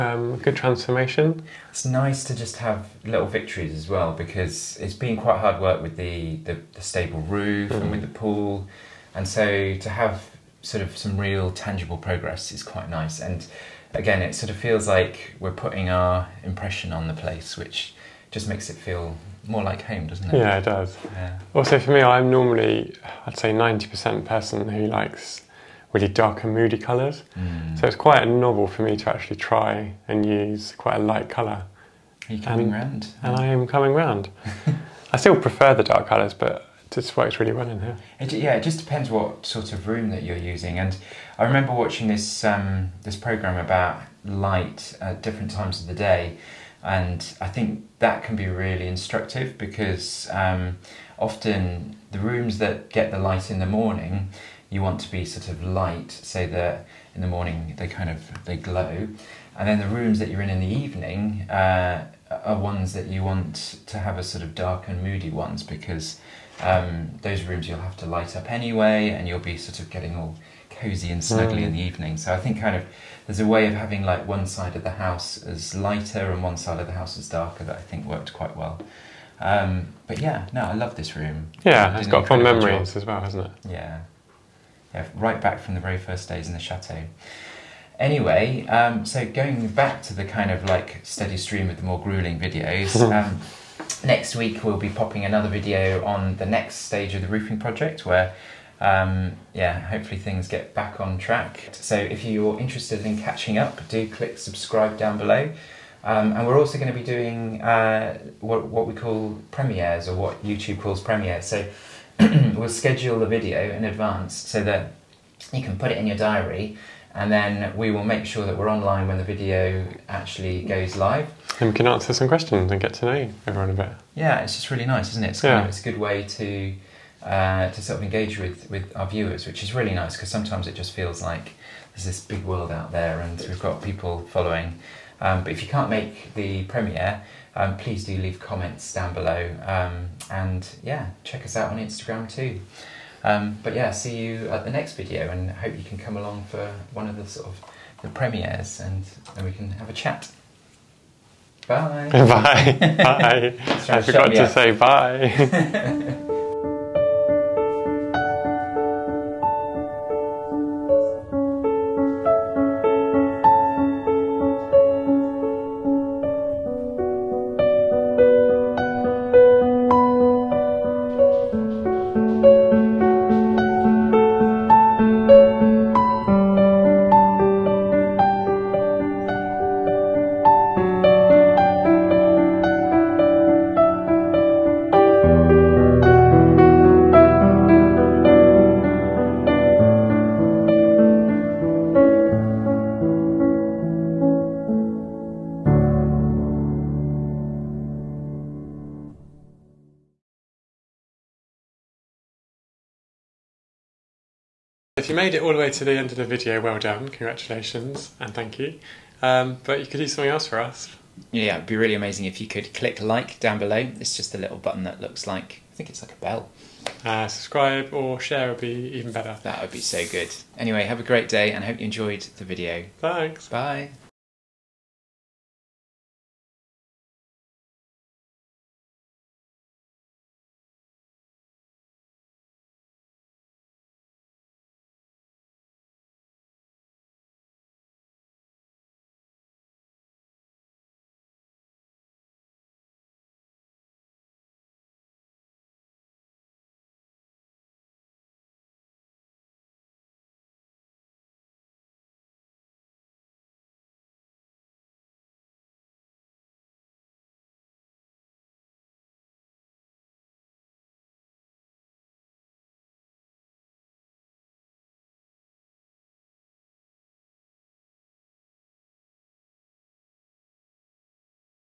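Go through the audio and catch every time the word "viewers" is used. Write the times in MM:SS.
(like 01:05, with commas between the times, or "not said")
02:09.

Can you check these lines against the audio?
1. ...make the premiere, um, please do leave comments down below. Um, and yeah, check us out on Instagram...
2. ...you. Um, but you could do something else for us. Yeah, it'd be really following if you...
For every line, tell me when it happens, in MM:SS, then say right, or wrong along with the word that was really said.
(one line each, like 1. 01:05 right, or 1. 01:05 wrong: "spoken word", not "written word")
1. 02:15 right
2. 03:28 wrong: "amazing", not "following".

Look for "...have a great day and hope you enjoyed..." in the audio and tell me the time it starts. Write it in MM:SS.
03:40.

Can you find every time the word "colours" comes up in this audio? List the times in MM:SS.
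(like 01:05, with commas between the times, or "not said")
00:26, 00:31, 00:36.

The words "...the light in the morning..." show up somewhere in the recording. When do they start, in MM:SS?
00:53.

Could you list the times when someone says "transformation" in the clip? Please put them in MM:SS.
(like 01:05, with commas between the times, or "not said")
00:00.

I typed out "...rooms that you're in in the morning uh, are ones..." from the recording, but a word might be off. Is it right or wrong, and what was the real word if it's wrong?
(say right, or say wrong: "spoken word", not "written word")
wrong: "evening", not "morning".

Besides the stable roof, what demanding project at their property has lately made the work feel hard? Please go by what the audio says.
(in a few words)
The pool.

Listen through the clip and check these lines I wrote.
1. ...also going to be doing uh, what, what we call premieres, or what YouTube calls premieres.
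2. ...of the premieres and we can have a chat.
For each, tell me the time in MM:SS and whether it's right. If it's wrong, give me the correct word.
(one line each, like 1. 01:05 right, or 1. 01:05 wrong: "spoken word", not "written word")
1. 01:46 right
2. 02:27 right.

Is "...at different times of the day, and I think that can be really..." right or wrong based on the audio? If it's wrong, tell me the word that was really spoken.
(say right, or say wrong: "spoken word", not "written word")
right.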